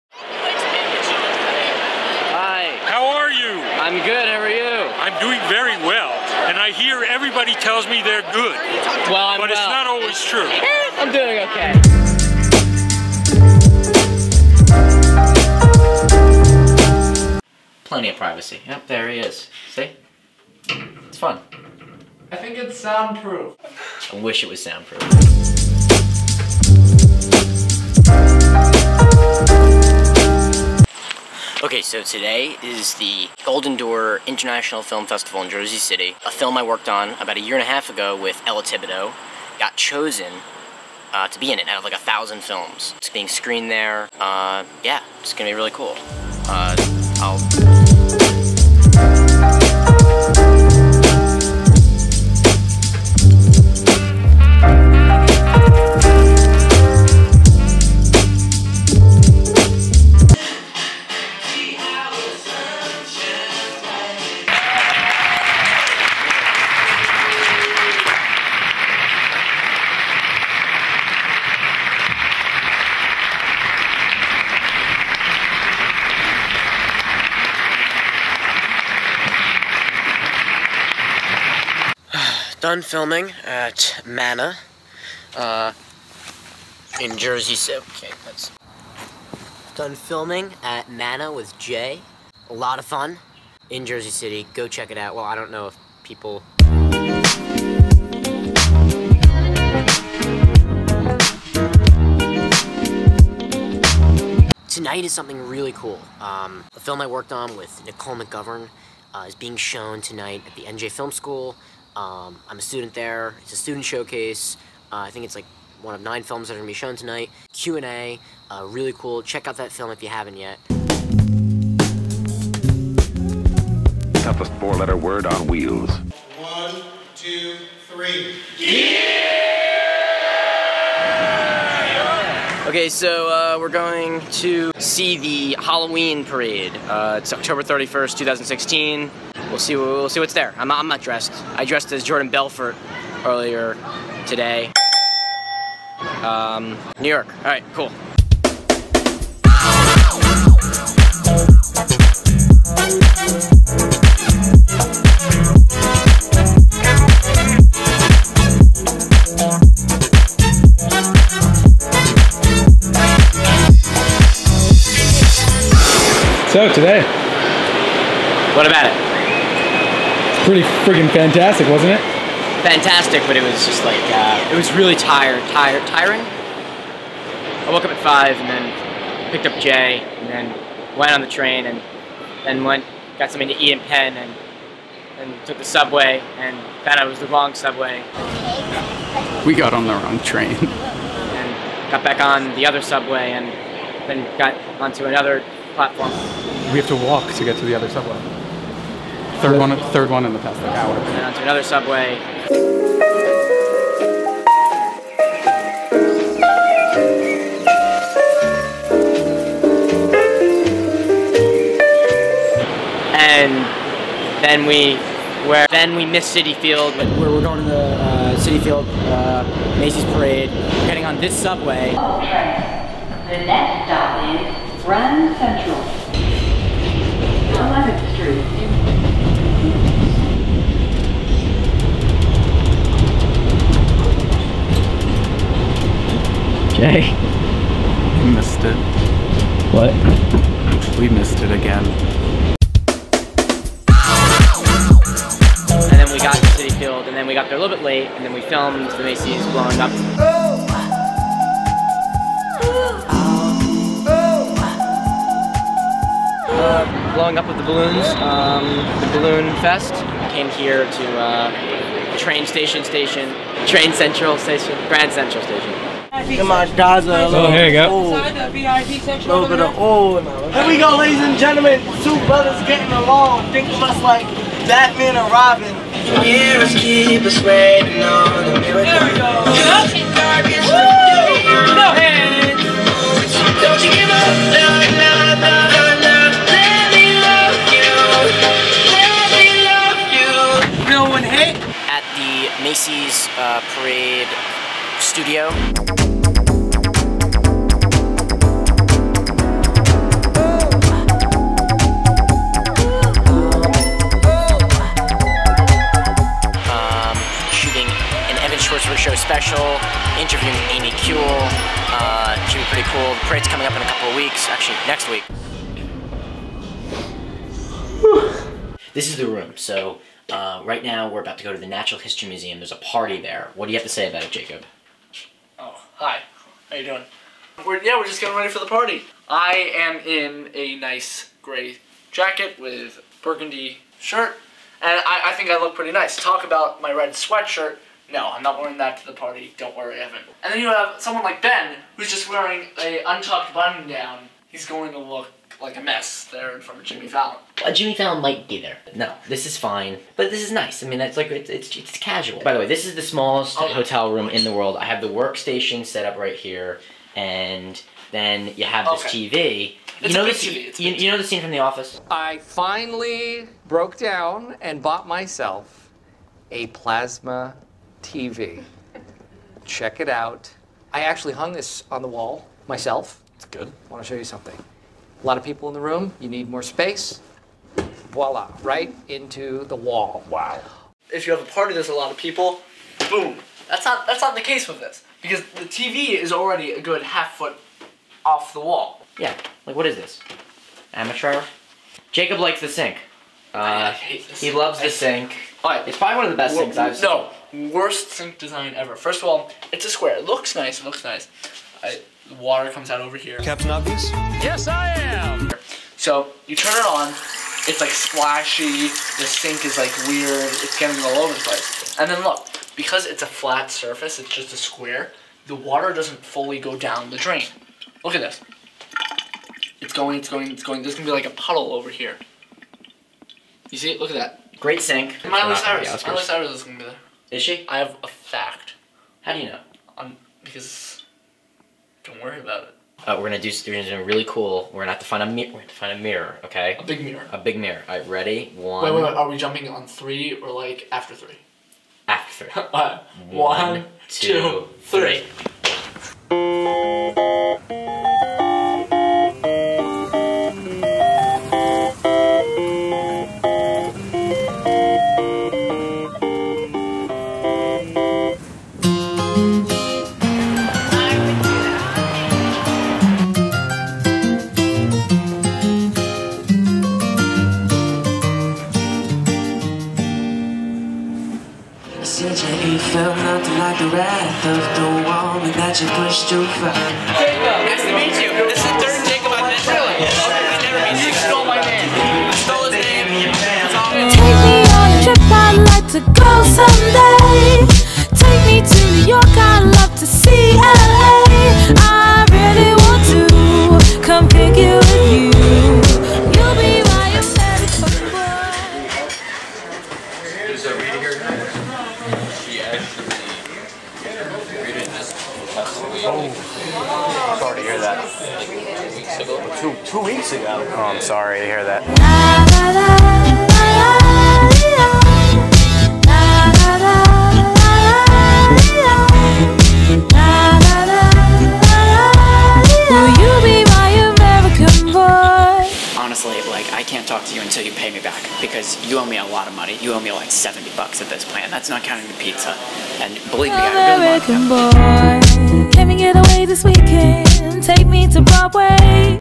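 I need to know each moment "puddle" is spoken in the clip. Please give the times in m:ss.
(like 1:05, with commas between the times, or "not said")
7:01.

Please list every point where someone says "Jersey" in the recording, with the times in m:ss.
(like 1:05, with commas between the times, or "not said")
0:35, 1:27, 1:33.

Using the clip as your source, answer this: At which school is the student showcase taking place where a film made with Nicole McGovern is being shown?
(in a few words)
NJ Film School.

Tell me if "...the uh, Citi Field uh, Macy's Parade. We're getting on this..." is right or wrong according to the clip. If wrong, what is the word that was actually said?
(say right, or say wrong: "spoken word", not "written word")
right.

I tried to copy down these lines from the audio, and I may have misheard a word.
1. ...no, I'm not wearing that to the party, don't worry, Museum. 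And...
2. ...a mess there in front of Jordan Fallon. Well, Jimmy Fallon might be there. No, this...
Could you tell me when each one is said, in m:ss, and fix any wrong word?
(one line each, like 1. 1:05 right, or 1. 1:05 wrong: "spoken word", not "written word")
1. 5:38 wrong: "Evan", not "Museum"
2. 5:45 wrong: "Jimmy", not "Jordan".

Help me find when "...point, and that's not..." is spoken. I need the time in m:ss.
8:51.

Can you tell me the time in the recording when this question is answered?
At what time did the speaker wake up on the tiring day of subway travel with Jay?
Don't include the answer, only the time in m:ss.
2:58.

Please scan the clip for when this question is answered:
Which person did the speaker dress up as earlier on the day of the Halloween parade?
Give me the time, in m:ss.
2:22.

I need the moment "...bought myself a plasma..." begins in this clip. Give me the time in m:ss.
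6:04.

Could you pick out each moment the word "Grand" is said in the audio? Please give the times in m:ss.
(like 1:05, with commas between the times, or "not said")
3:44, 4:24.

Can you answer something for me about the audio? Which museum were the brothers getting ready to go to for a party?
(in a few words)
Natural History Museum.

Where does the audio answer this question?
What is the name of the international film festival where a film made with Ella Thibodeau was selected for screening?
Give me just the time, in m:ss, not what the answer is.
0:33.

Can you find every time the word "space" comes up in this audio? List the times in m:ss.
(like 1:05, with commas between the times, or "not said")
6:16.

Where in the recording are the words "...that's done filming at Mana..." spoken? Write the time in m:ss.
1:28.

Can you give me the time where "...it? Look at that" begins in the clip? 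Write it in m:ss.
7:03.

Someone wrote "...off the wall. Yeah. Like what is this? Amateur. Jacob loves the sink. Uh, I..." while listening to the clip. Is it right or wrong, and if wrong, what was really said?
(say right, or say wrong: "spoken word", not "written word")
wrong: "likes", not "loves".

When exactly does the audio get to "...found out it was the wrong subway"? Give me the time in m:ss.
3:06.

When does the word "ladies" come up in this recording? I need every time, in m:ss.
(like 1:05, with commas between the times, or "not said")
4:30.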